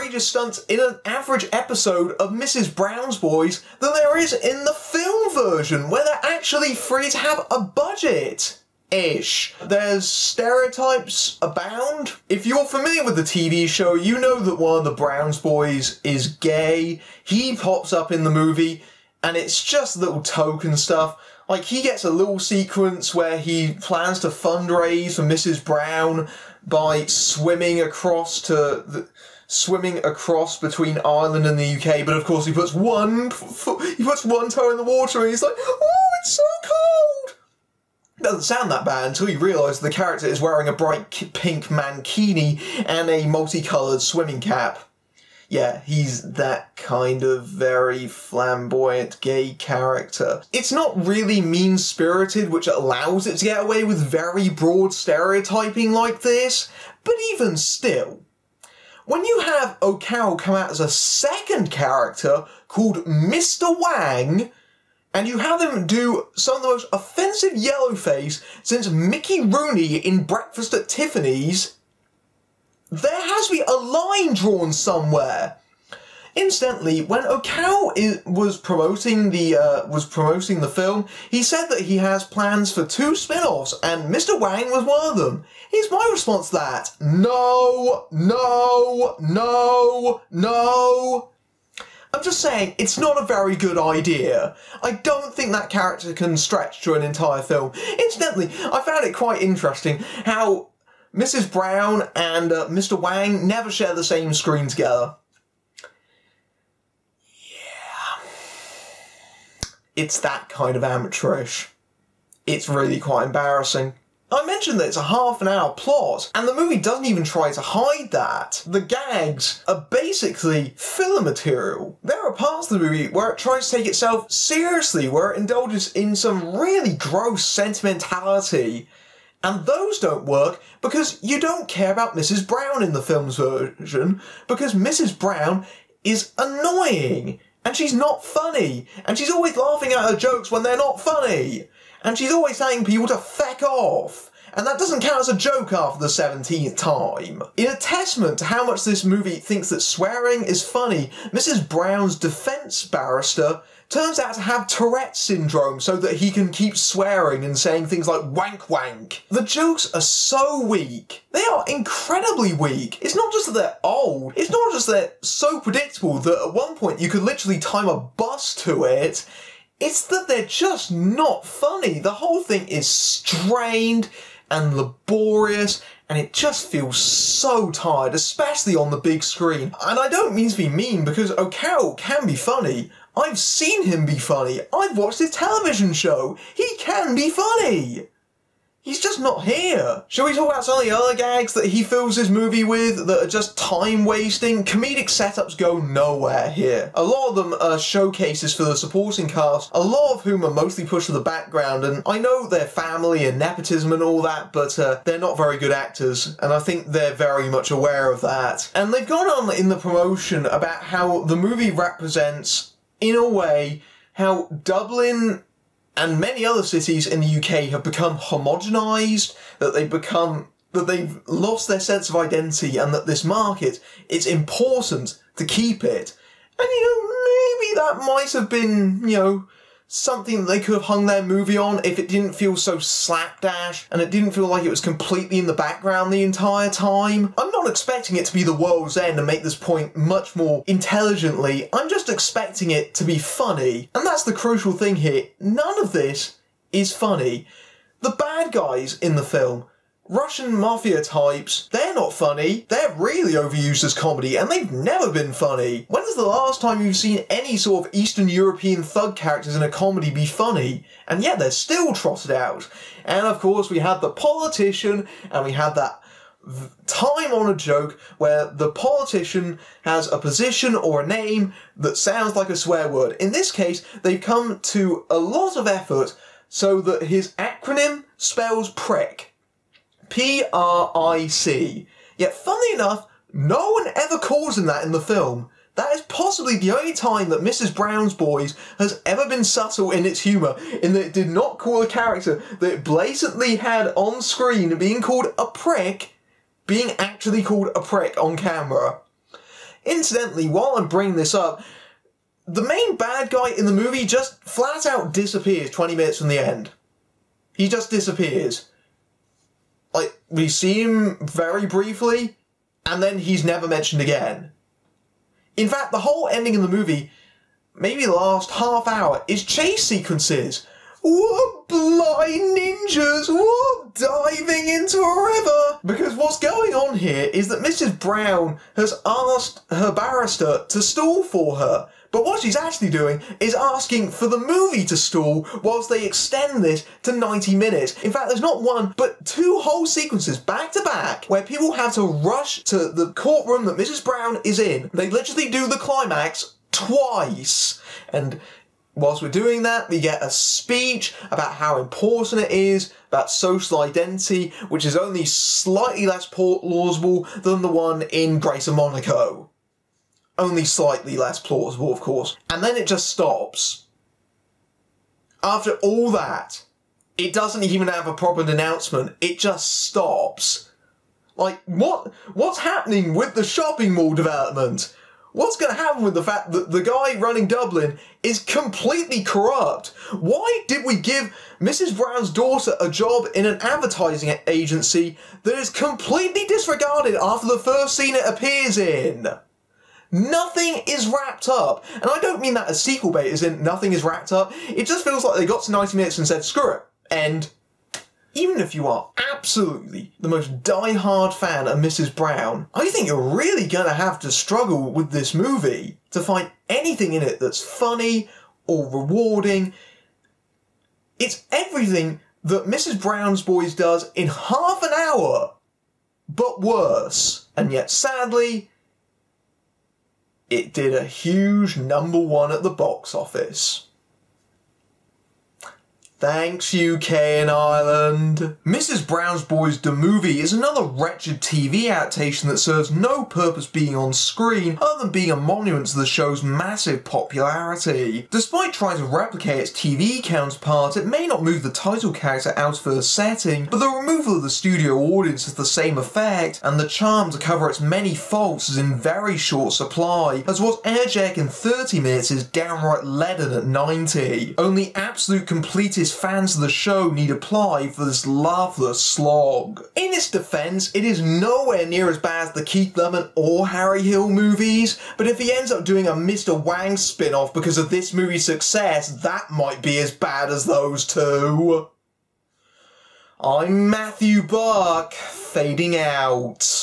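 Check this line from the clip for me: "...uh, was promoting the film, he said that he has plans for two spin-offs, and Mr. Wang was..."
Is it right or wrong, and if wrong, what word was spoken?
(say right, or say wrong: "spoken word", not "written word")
right.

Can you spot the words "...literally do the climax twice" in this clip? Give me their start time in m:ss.
5:45.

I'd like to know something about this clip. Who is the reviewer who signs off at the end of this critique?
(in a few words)
Matthew Buck.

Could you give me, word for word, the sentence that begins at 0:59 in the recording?
When you have O'Carroll come out as a second character called Mr.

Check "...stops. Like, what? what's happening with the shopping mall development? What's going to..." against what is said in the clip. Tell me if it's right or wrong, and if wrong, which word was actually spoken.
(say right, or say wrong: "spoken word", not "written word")
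right.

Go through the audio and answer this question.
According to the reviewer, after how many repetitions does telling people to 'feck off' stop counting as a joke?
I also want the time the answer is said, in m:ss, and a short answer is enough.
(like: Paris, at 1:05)
17, at 2:26.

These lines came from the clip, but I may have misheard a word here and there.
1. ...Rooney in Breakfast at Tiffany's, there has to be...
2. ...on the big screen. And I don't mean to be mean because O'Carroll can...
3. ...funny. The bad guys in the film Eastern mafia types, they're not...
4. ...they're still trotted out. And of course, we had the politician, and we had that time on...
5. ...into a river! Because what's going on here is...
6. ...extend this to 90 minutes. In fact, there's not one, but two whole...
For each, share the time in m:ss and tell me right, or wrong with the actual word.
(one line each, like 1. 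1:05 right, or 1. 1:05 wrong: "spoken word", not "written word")
1. 1:09 right
2. 2:58 right
3. 4:06 wrong: "Russian", not "Eastern"
4. 4:21 right
5. 5:24 right
6. 5:36 right.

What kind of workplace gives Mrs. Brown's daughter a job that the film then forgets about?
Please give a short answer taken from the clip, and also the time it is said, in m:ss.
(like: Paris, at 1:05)
advertising agency, at 6:23.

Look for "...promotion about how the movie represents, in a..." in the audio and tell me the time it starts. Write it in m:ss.
3:29.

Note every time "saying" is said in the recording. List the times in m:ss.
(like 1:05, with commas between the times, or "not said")
1:32, 2:37.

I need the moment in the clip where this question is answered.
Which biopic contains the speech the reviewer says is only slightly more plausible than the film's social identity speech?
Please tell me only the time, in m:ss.
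5:58.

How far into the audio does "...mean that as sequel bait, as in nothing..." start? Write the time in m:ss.
6:32.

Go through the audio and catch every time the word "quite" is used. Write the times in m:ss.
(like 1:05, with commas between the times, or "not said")
1:39, 1:53.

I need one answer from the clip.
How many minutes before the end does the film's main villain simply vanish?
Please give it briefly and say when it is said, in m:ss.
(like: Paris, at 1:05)
20, at 5:05.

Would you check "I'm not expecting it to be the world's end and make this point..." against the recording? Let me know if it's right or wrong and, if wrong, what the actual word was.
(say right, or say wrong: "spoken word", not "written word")
right.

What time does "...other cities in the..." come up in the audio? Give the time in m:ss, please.
3:36.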